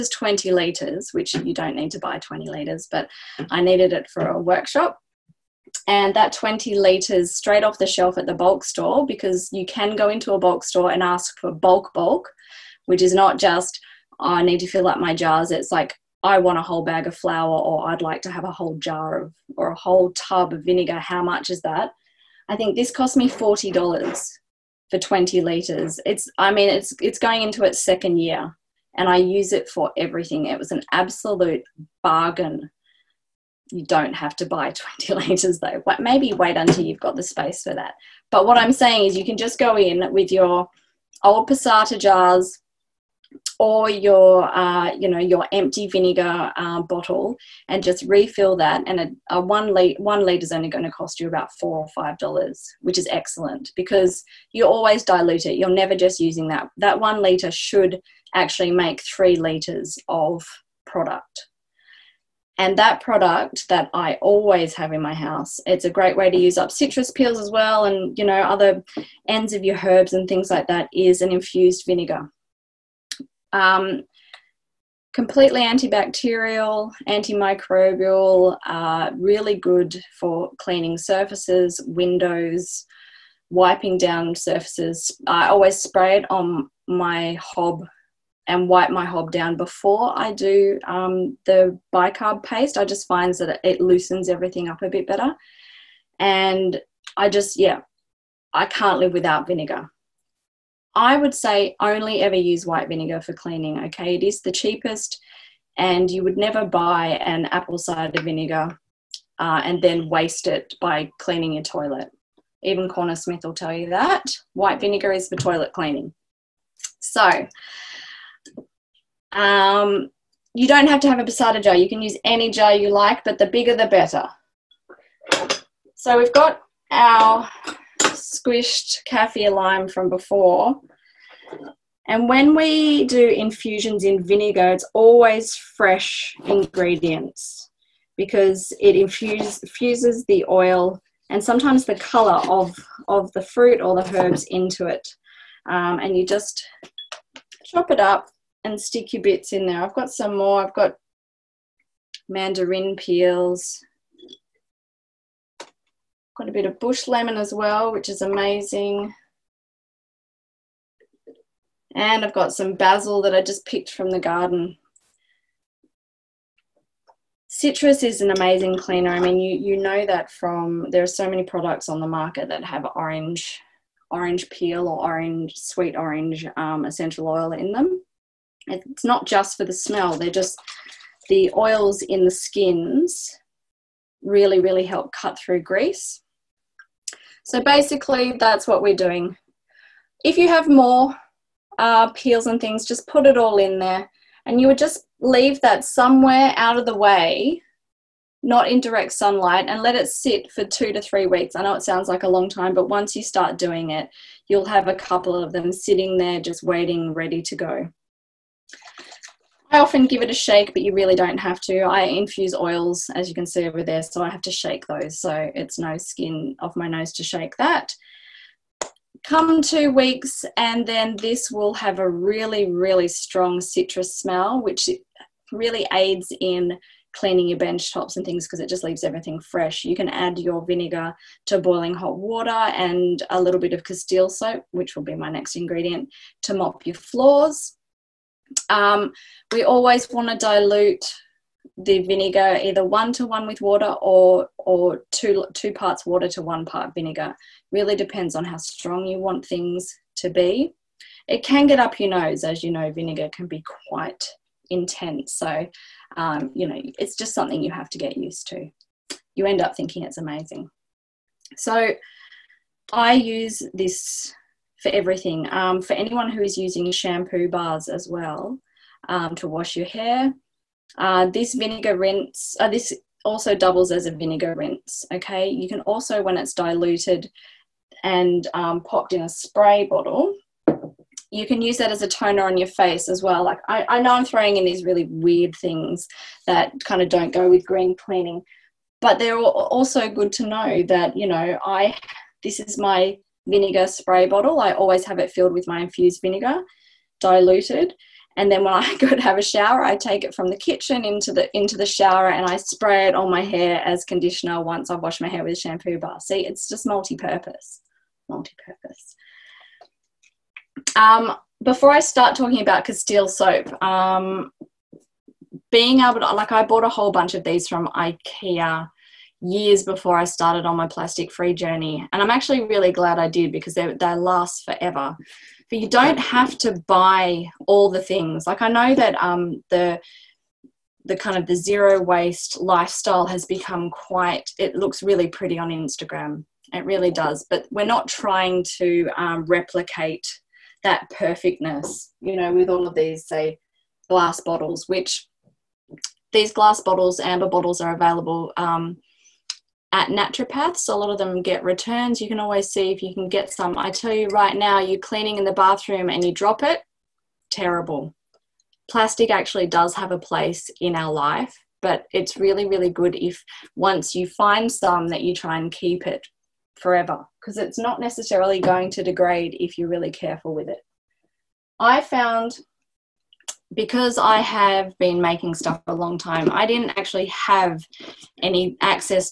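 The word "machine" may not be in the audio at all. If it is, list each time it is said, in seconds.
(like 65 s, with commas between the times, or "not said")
not said.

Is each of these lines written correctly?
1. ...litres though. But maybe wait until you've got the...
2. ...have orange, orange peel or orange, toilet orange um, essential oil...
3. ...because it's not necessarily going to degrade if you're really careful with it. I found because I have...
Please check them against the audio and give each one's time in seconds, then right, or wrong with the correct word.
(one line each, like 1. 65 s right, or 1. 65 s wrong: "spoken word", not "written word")
1. 35 s right
2. 172 s wrong: "sweet", not "toilet"
3. 367 s right.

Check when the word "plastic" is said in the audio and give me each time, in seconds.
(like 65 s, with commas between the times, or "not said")
320 s, 358 s.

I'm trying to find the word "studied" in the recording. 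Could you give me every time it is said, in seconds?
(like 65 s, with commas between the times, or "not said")
not said.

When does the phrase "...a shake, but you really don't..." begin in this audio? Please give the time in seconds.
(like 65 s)
210 s.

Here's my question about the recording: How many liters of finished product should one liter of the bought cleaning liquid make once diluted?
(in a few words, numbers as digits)
3 liters.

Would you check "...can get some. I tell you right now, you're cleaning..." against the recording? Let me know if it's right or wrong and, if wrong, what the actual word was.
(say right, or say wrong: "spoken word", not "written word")
right.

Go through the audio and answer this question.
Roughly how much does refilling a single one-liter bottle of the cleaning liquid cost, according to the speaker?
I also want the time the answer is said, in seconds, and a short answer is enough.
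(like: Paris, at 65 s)
4 or 5 dollars, at 51 s.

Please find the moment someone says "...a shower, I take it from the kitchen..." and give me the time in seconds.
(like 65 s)
299 s.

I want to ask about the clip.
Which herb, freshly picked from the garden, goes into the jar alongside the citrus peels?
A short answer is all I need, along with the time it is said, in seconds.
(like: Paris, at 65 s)
Basil, at 162 s.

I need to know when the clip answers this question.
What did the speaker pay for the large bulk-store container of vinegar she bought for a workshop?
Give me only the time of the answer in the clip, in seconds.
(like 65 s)
23 s.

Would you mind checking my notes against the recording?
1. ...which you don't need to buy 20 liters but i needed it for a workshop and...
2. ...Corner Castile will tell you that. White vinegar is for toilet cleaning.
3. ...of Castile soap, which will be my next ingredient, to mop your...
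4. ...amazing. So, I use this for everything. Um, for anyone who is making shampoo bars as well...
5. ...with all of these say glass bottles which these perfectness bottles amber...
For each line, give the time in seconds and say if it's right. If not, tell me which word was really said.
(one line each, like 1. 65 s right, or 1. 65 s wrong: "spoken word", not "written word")
1. 1 s right
2. 112 s wrong: "Smith", not "Castile"
3. 233 s right
4. 260 s wrong: "using", not "making"
5. 342 s wrong: "glass", not "perfectness".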